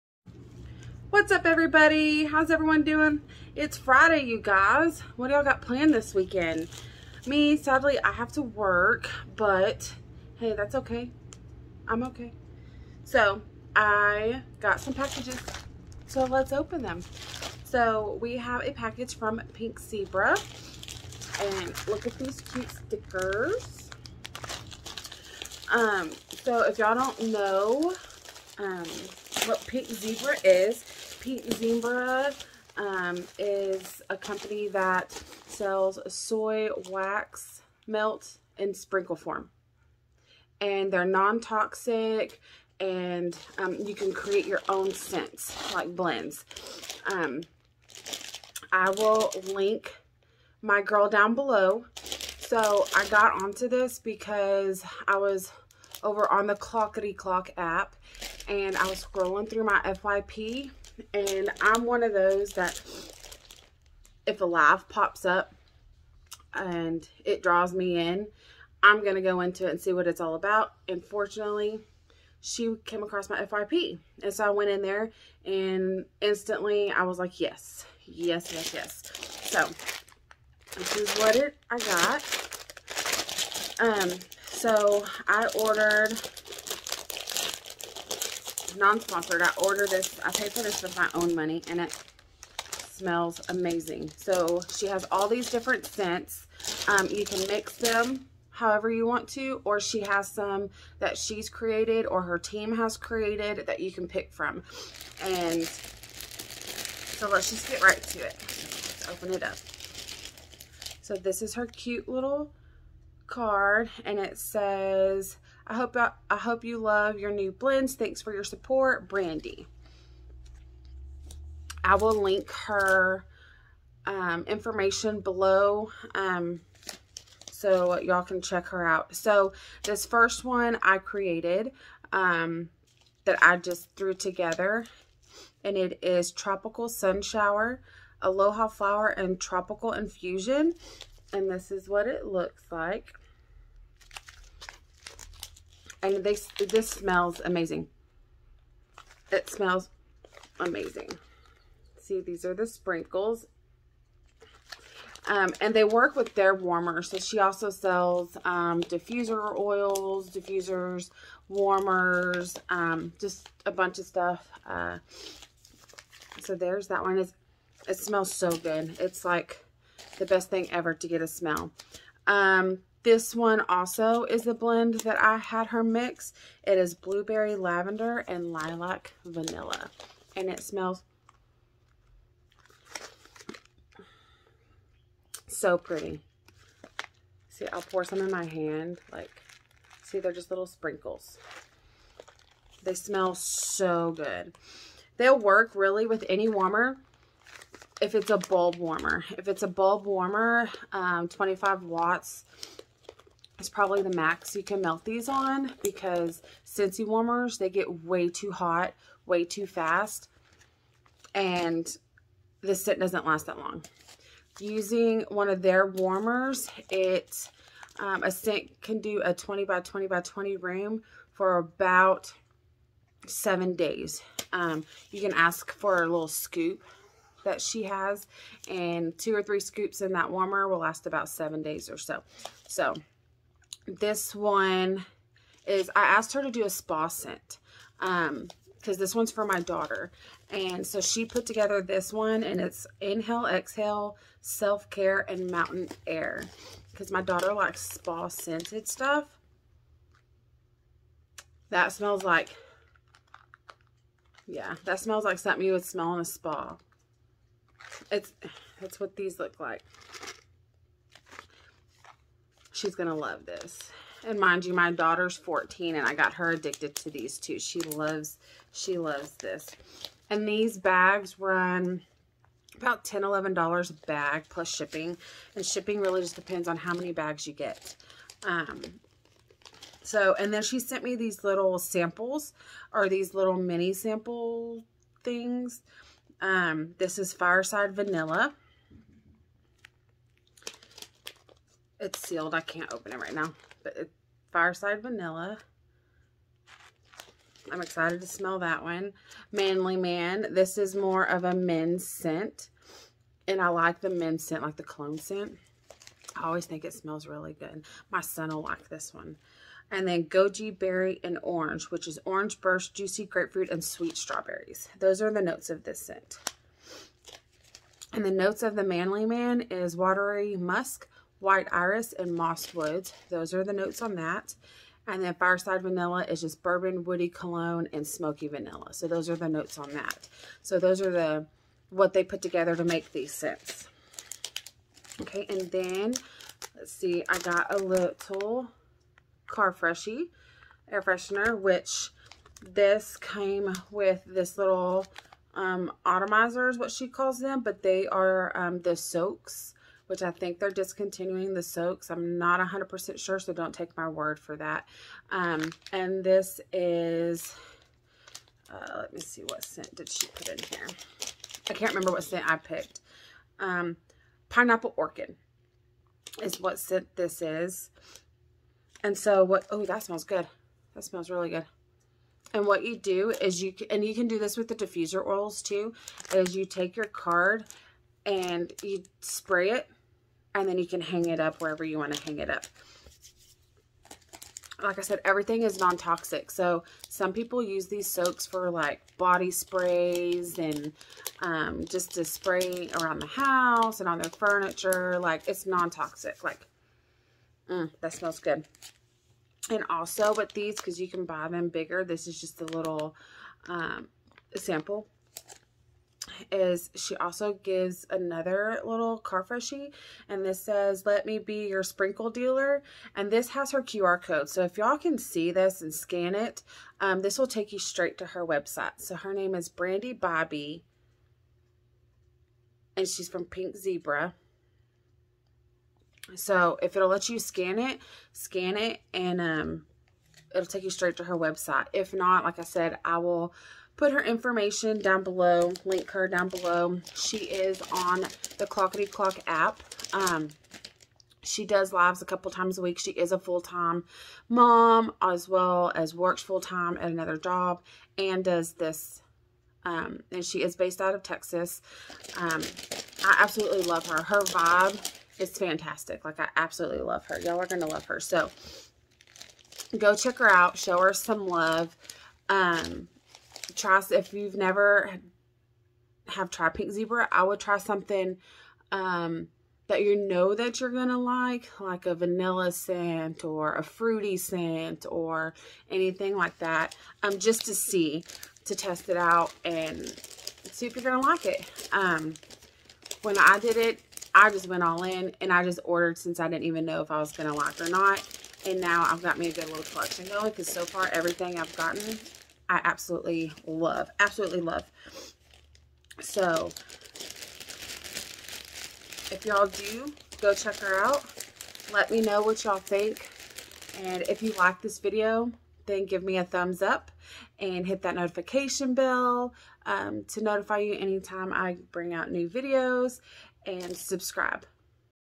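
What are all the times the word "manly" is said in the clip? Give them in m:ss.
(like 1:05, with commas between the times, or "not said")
4:59, 5:18.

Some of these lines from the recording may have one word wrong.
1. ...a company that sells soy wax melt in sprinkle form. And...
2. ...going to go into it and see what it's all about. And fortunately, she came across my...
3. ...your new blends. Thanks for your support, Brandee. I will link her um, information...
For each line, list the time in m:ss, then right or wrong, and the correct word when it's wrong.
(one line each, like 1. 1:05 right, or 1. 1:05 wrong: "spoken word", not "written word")
1. 0:34 right
2. 1:09 right
3. 1:57 right.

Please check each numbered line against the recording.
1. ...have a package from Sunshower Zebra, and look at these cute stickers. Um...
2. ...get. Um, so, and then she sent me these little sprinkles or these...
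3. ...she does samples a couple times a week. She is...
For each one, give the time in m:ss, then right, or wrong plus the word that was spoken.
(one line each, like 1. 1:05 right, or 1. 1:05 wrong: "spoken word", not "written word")
1. 0:18 wrong: "Pink", not "Sunshower"
2. 4:37 wrong: "samples", not "sprinkles"
3. 7:21 wrong: "lives", not "samples".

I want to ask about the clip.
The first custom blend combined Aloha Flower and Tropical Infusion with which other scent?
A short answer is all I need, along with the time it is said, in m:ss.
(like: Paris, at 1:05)
Tropical Sunshower, at 2:16.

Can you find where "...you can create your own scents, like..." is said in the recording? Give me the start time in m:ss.
0:43.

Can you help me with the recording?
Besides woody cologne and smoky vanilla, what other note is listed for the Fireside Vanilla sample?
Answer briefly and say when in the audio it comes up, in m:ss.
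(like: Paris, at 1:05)
bourbon, at 5:26.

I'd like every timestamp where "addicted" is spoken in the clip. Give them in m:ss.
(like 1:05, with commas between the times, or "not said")
4:26.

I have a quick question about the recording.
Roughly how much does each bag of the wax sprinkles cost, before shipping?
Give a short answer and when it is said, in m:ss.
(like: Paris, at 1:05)
$11, at 4:33.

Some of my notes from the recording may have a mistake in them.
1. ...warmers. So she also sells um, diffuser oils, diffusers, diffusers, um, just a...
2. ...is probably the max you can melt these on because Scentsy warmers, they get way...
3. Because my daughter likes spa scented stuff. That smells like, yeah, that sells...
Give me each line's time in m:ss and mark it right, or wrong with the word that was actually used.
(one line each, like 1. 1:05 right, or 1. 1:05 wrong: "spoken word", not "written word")
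1. 2:36 wrong: "warmers", not "diffusers"
2. 3:23 right
3. 4:06 wrong: "smells", not "sells".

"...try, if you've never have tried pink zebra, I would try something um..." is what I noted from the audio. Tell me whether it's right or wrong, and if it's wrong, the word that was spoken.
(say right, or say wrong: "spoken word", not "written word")
right.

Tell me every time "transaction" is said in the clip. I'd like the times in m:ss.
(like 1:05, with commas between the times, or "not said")
not said.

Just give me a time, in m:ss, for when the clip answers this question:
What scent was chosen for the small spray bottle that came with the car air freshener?
6:04.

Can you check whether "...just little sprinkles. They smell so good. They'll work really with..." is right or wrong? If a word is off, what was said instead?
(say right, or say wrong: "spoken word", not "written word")
right.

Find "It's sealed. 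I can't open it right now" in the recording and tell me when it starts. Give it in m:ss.
4:52.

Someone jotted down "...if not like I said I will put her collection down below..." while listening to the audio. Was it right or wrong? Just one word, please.
wrong.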